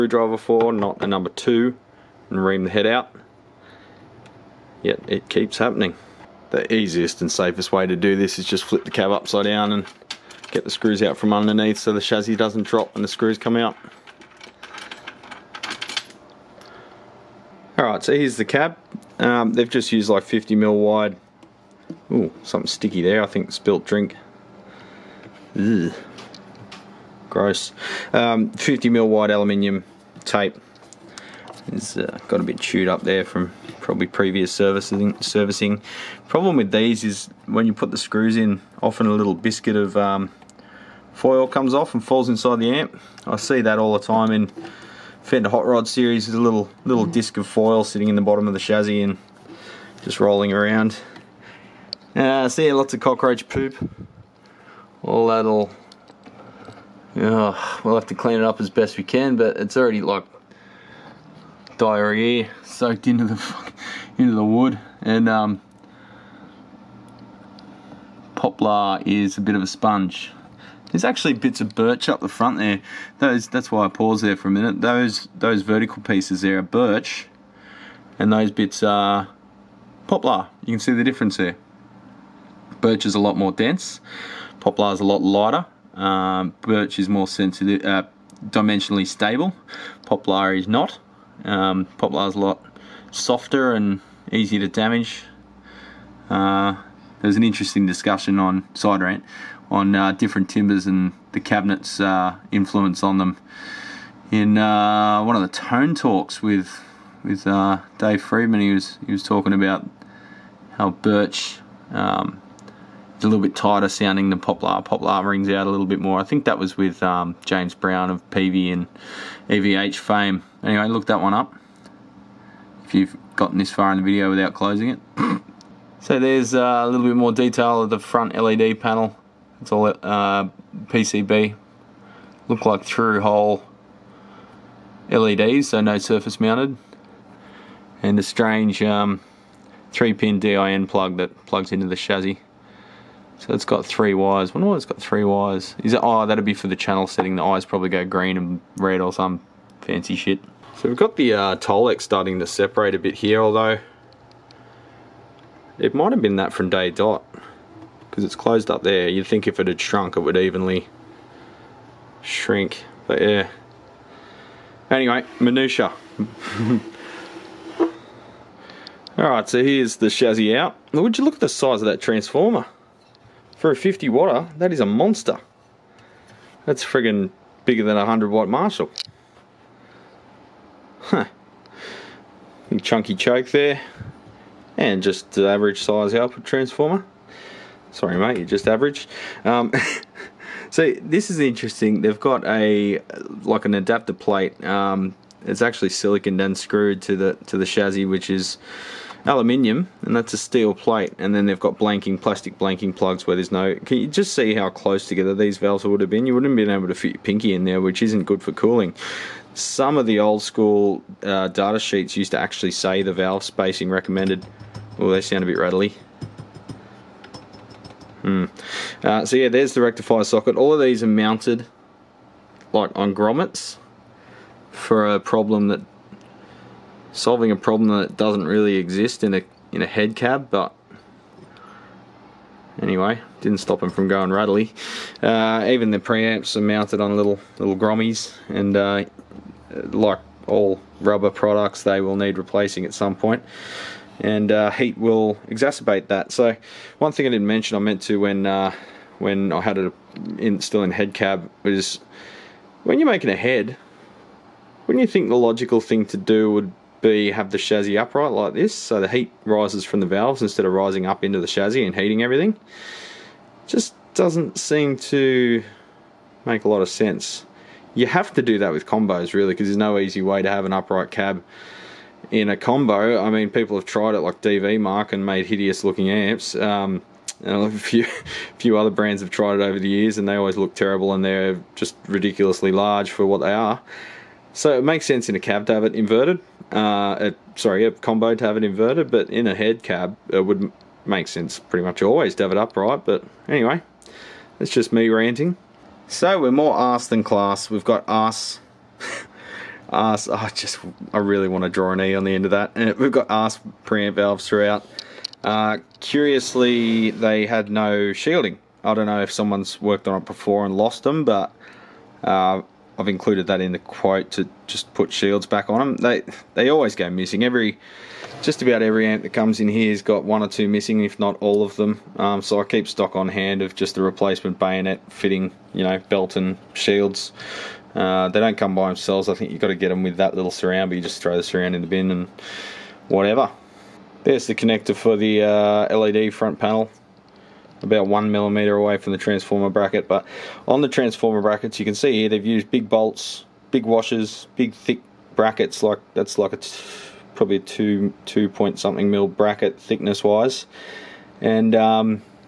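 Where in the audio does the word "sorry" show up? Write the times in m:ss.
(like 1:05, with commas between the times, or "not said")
3:07, 4:47.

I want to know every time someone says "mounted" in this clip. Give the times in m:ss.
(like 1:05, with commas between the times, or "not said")
2:16, 3:41, 3:56.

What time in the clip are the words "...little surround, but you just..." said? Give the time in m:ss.
5:30.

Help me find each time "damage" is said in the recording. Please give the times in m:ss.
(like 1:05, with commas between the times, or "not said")
1:34.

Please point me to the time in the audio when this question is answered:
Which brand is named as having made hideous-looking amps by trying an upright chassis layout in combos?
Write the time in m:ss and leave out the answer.
4:34.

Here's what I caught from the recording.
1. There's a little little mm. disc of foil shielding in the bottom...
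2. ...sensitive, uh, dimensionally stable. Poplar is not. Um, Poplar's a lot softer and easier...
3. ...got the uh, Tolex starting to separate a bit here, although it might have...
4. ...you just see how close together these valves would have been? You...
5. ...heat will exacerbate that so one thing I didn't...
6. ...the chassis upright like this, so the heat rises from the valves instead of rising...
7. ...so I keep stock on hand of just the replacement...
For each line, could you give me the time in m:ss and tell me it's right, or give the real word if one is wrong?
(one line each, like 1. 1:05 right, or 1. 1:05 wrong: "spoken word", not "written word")
1. 0:46 wrong: "sitting", not "shielding"
2. 1:27 right
3. 2:30 right
4. 3:23 right
5. 4:04 right
6. 4:17 right
7. 5:22 right.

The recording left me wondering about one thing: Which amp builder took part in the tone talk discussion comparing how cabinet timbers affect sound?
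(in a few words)
Dave Friedman.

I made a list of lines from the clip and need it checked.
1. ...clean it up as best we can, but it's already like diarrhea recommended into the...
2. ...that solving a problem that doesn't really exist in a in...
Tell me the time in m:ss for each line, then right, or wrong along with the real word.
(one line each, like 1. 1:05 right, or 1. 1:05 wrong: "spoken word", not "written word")
1. 0:58 wrong: "soaked", not "recommended"
2. 3:45 right.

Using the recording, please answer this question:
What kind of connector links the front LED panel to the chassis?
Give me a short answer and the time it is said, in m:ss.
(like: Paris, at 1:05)
3-pin DIN plug, at 2:19.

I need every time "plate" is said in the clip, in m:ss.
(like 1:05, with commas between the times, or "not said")
3:14, 3:20.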